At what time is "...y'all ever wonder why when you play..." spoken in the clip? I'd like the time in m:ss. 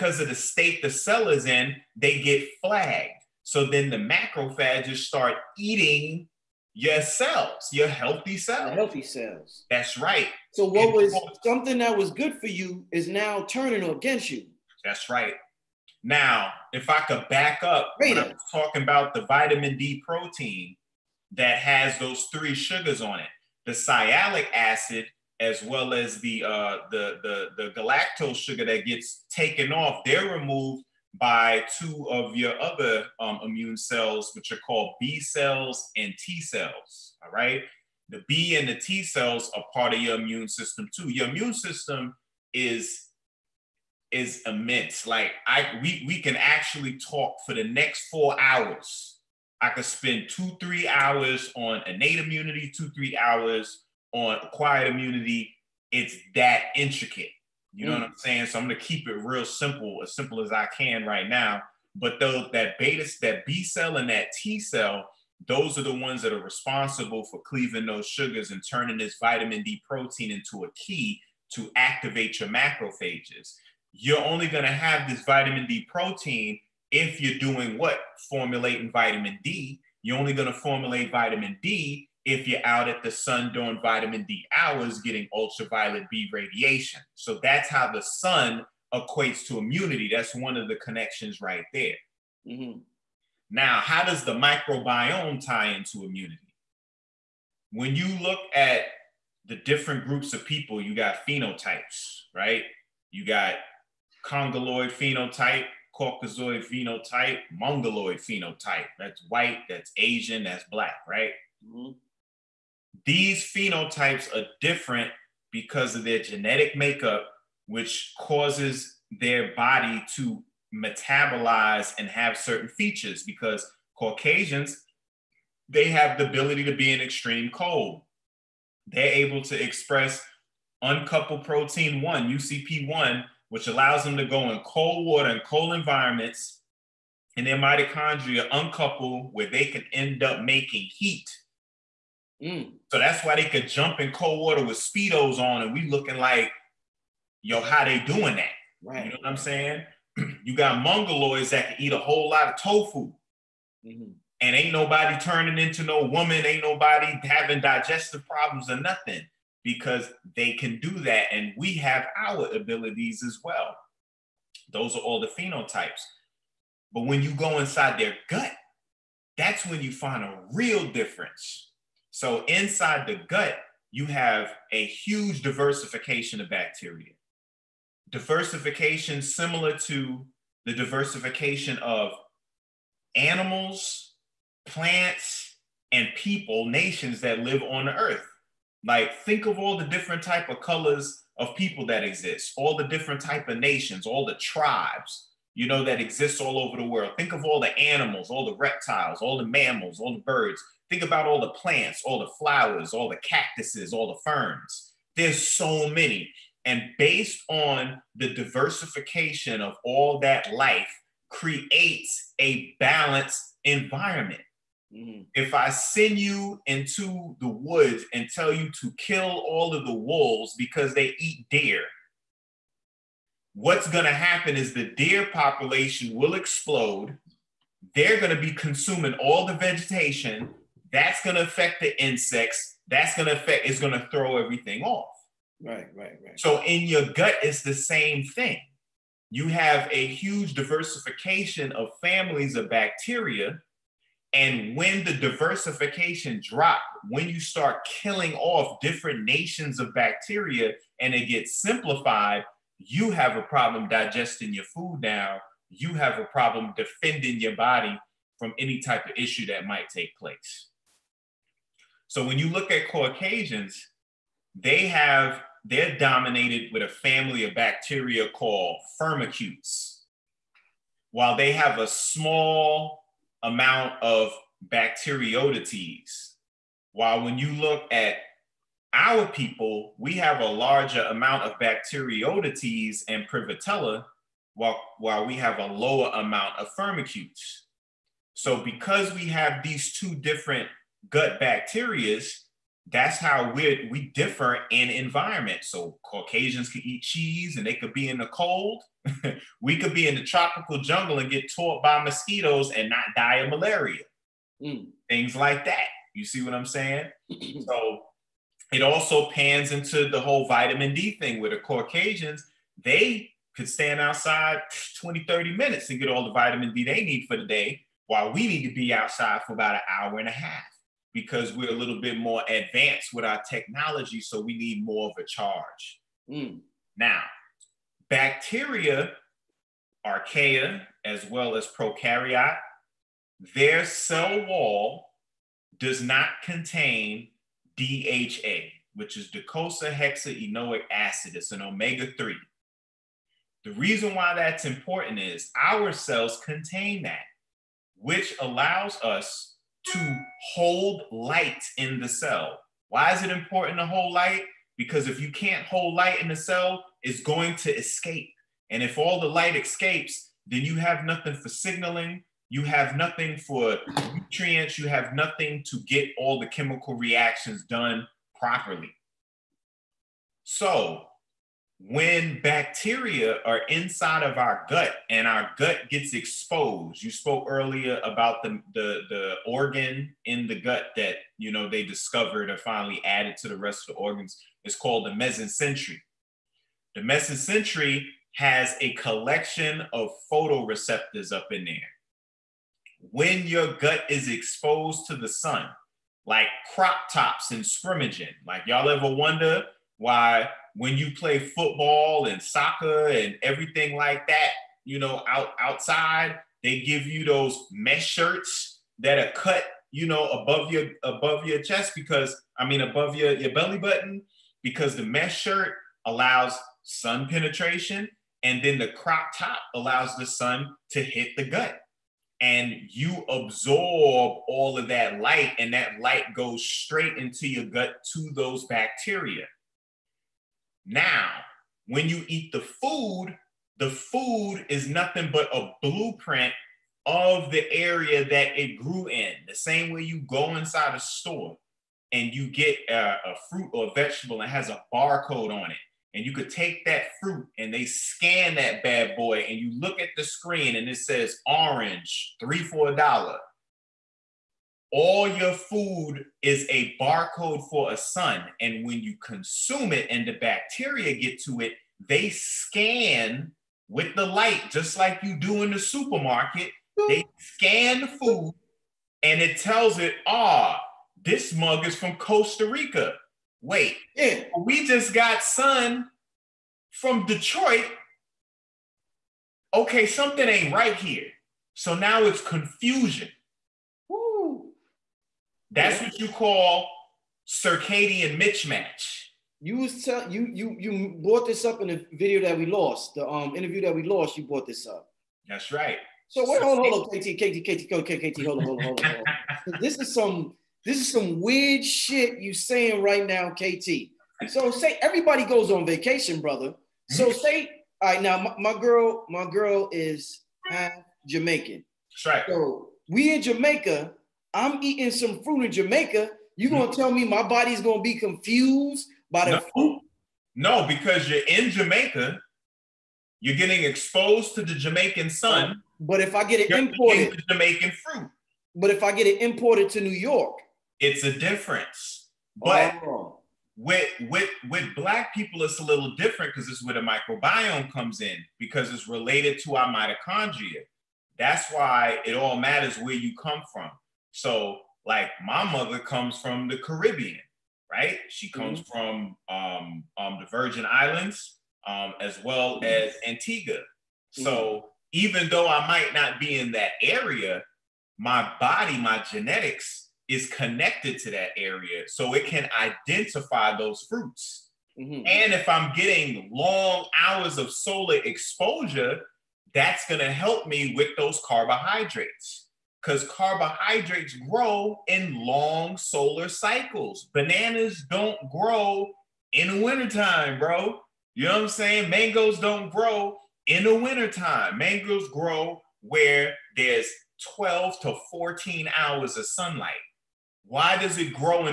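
6:38.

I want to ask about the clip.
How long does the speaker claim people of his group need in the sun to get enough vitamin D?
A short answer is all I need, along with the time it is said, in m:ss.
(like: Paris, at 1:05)
an hour and a half, at 5:19.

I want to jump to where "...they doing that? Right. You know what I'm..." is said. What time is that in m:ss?
2:27.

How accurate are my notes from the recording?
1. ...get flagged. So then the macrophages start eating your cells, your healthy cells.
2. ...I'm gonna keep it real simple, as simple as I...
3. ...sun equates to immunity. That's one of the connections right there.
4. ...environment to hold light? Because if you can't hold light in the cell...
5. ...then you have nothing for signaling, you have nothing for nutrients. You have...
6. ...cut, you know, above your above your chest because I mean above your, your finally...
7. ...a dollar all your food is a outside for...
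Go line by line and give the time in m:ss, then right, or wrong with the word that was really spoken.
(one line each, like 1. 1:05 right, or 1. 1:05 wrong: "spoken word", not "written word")
1. 0:02 right
2. 0:58 right
3. 1:28 right
4. 5:53 wrong: "important", not "environment"
5. 6:00 right
6. 6:49 wrong: "belly", not "finally"
7. 7:32 wrong: "barcode", not "outside".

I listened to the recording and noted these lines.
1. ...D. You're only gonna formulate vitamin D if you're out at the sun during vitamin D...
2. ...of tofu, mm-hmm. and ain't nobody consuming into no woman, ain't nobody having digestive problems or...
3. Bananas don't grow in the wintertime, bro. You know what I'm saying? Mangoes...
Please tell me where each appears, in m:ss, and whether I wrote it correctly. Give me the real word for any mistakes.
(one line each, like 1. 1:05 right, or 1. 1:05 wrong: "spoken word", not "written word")
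1. 1:19 right
2. 2:32 wrong: "turning", not "consuming"
3. 9:37 right.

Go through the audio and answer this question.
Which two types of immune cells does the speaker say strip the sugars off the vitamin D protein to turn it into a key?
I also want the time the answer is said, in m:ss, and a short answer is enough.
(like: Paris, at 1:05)
B cells and T cells, at 0:34.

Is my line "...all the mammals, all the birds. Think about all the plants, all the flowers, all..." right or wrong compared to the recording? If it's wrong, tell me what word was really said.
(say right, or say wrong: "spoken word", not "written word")
right.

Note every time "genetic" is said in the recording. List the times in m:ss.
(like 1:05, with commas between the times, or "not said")
1:56, 9:19.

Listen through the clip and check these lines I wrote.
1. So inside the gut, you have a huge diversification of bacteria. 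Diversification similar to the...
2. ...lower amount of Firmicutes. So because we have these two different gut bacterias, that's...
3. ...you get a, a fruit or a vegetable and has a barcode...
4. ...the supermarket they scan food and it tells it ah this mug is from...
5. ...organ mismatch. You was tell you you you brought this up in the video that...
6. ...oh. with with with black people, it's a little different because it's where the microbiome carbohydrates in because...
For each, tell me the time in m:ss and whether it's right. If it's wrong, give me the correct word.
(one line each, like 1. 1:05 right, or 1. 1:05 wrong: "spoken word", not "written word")
1. 2:52 right
2. 4:45 right
3. 7:22 right
4. 7:45 right
5. 8:07 wrong: "circadian", not "organ"
6. 8:53 wrong: "comes", not "carbohydrates".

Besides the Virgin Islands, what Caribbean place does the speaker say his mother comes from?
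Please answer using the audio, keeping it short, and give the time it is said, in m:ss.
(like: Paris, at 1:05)
Antigua, at 9:13.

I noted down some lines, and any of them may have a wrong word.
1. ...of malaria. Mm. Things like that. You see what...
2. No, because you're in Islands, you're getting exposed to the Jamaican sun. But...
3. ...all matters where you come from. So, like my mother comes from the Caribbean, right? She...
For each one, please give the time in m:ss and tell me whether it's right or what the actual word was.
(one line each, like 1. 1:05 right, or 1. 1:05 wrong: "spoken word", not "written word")
1. 5:03 right
2. 8:40 wrong: "Jamaica", not "Islands"
3. 9:02 right.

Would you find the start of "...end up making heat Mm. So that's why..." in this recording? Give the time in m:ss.
2:19.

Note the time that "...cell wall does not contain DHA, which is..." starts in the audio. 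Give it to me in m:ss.
5:33.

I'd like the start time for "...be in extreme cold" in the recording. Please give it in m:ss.
2:06.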